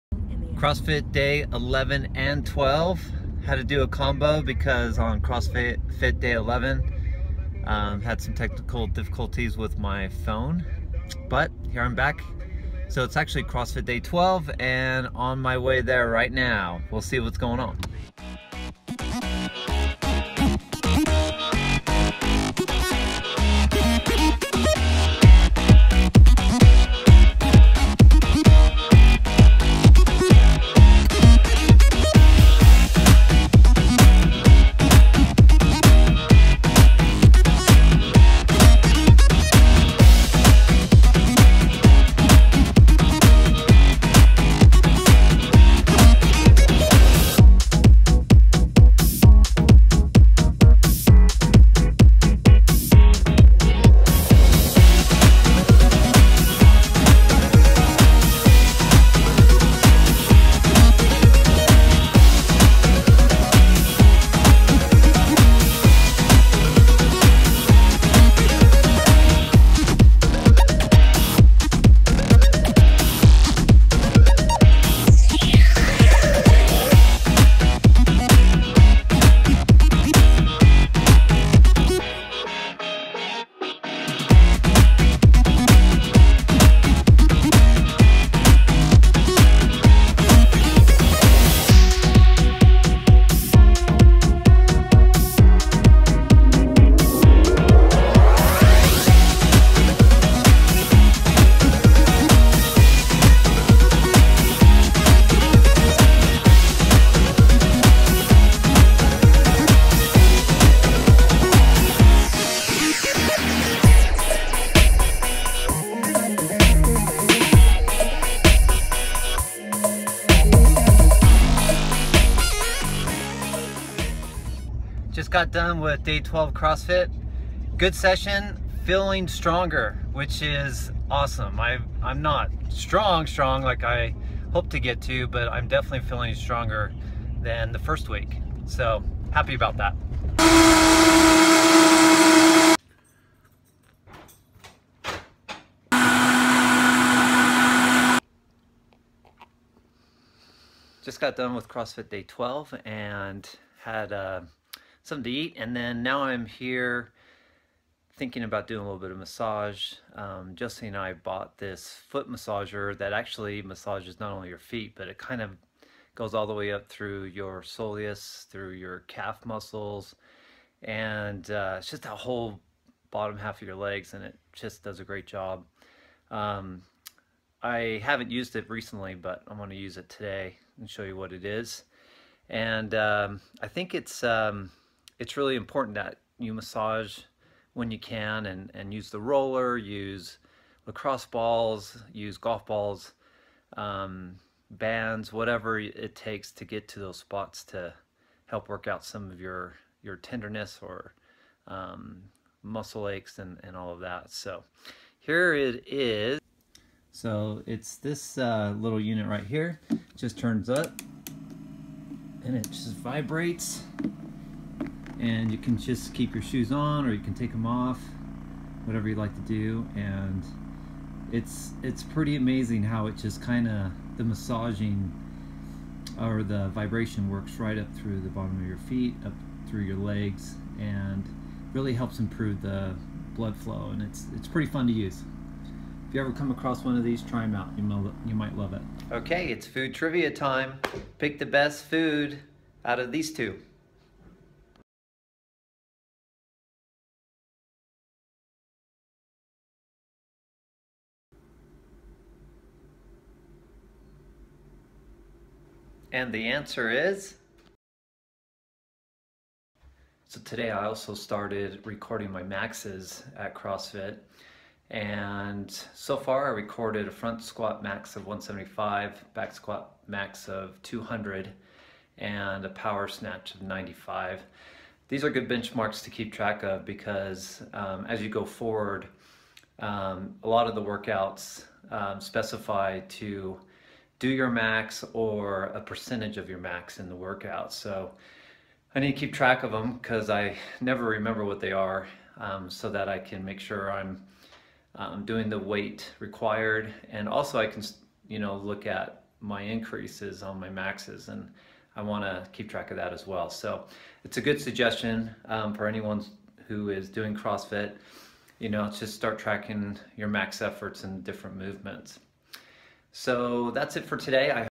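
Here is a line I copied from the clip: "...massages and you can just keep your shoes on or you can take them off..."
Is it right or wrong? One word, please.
wrong.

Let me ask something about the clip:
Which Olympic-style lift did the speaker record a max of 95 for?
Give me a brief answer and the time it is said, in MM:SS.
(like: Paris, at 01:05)
Power snatch, at 04:32.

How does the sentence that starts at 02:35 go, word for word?
And then now I'm here thinking about doing a little bit of massage.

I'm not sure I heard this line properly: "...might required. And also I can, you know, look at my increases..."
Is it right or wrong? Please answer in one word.
wrong.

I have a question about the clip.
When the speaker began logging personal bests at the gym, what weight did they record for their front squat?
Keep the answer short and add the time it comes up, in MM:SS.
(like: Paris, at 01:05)
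175, at 04:28.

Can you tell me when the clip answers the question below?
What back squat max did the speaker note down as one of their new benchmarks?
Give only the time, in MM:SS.
04:30.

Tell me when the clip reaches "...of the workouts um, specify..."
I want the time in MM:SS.
04:40.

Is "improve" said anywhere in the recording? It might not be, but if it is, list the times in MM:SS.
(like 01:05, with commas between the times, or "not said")
03:52.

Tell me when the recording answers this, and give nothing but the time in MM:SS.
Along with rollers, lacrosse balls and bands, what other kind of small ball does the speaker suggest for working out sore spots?
03:12.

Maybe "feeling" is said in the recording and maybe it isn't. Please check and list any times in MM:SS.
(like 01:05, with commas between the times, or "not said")
02:08, 02:16.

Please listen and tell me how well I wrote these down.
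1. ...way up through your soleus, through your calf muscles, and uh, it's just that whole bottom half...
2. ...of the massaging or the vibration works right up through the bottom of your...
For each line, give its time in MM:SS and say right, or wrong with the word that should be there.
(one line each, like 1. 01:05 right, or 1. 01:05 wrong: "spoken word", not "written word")
1. 02:46 right
2. 03:43 right.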